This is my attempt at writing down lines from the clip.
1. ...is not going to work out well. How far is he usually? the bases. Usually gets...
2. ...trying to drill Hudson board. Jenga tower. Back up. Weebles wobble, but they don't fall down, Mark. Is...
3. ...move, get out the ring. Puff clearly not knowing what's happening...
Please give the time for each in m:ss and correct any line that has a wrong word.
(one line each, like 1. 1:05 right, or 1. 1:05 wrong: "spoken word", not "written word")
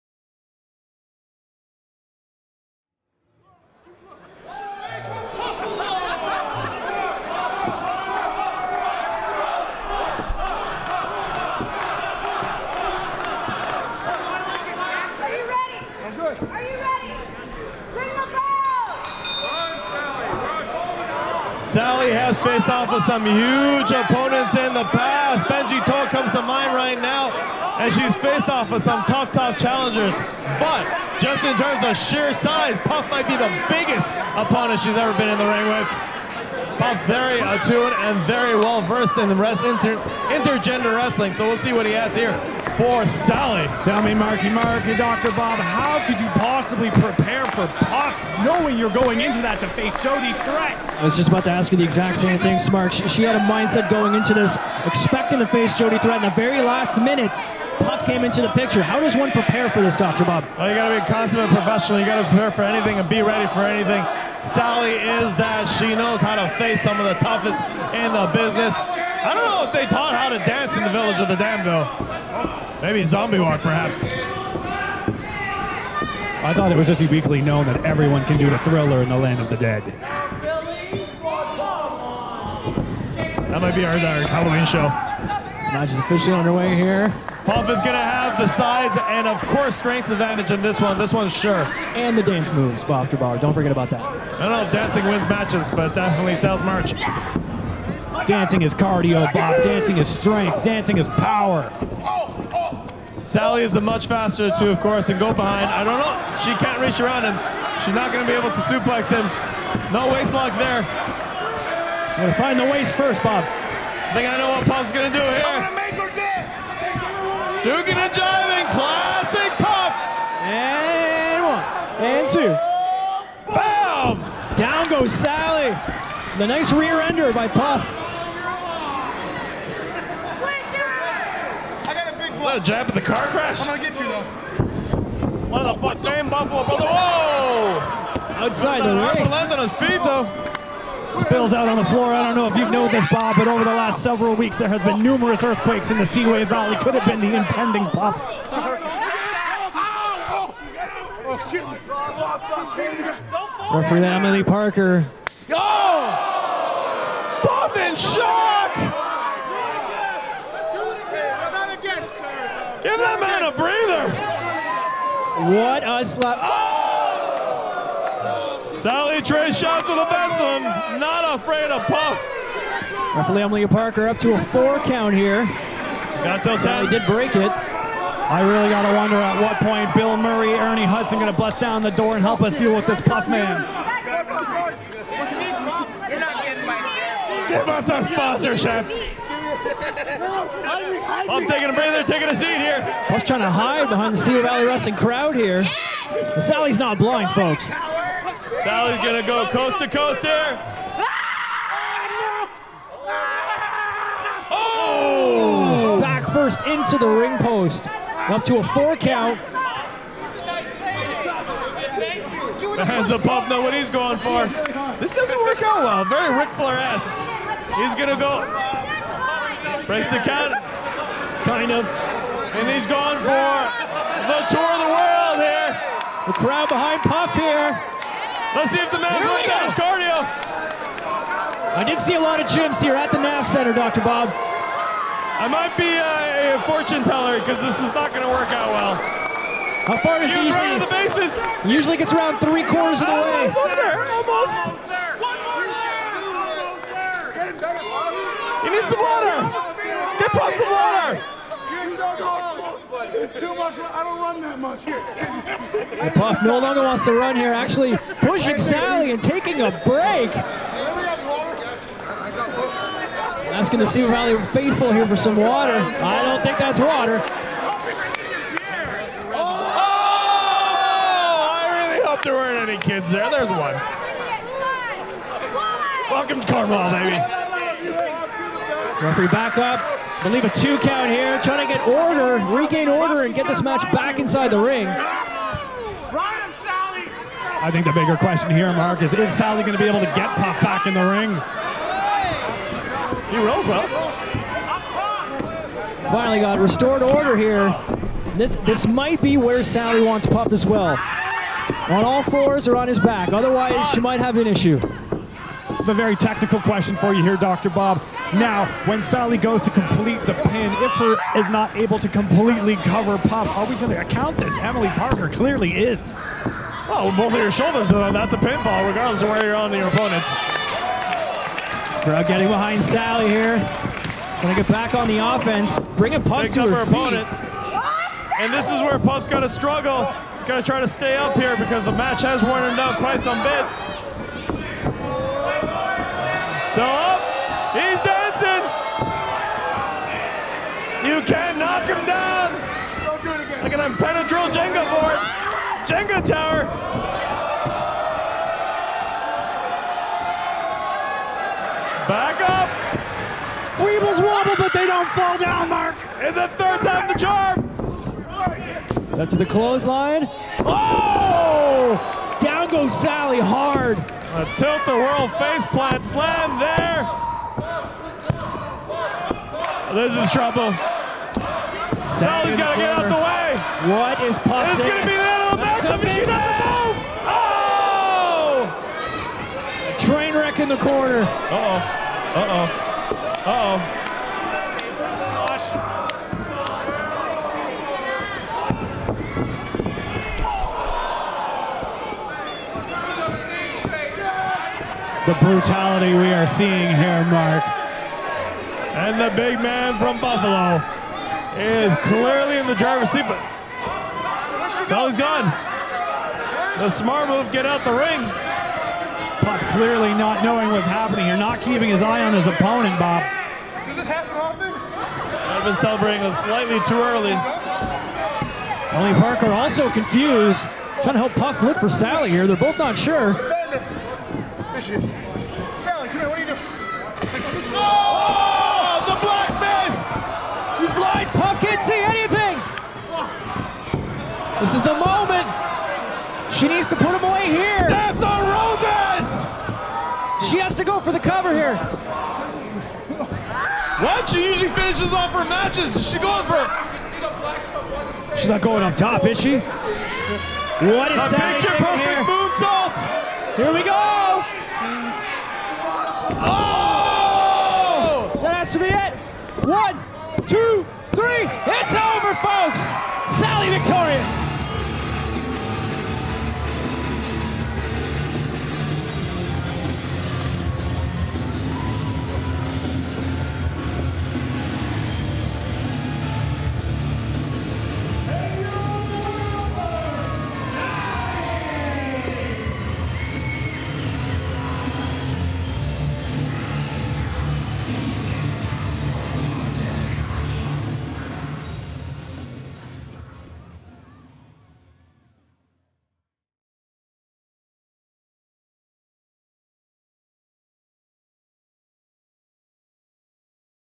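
1. 3:57 right
2. 5:43 wrong: "Jenga", not "Hudson"
3. 6:47 right.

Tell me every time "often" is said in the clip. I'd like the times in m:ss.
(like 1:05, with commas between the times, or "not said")
6:54.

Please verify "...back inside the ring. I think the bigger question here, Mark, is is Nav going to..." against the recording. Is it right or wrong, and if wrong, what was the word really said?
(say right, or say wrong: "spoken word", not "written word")
wrong: "Sally", not "Nav".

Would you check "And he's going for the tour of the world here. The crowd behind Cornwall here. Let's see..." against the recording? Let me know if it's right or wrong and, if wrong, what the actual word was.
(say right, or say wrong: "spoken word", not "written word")
wrong: "Puff", not "Cornwall".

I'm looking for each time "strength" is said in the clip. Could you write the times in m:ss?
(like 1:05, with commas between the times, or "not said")
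1:29, 1:40.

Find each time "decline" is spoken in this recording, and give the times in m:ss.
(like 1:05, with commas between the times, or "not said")
not said.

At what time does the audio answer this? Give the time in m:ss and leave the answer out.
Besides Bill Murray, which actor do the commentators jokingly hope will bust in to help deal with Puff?
3:00.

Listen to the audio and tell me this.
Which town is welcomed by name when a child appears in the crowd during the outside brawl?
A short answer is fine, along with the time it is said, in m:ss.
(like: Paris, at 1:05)
Cornwall, at 4:36.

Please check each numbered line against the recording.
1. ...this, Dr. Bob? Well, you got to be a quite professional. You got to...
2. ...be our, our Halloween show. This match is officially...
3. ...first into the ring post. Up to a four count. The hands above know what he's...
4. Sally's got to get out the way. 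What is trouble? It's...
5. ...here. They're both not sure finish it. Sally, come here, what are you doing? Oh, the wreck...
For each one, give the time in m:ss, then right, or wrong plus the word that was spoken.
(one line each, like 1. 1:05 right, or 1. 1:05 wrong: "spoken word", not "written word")
1. 0:59 wrong: "consummate", not "quite"
2. 1:23 right
3. 3:26 right
4. 6:12 wrong: "possible", not "trouble"
5. 7:02 wrong: "black", not "wreck".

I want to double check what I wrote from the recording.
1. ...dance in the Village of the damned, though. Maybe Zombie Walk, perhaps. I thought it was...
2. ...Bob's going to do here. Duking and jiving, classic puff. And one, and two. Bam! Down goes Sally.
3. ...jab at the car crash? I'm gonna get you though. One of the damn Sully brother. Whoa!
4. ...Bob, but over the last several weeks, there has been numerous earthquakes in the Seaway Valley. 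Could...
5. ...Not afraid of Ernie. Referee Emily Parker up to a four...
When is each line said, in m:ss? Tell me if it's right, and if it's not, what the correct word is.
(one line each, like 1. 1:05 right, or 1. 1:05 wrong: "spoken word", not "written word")
1. 1:10 right
2. 1:54 right
3. 2:12 wrong: "Buffalo", not "Sully"
4. 2:23 right
5. 2:50 wrong: "Puff", not "Ernie".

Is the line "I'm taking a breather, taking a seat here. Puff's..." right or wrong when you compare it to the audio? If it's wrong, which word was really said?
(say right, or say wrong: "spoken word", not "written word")
right.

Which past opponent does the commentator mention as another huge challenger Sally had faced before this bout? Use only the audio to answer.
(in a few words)
Benji Toll.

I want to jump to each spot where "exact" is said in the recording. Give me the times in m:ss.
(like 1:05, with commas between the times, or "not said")
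0:51.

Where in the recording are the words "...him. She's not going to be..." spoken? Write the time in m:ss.
1:47.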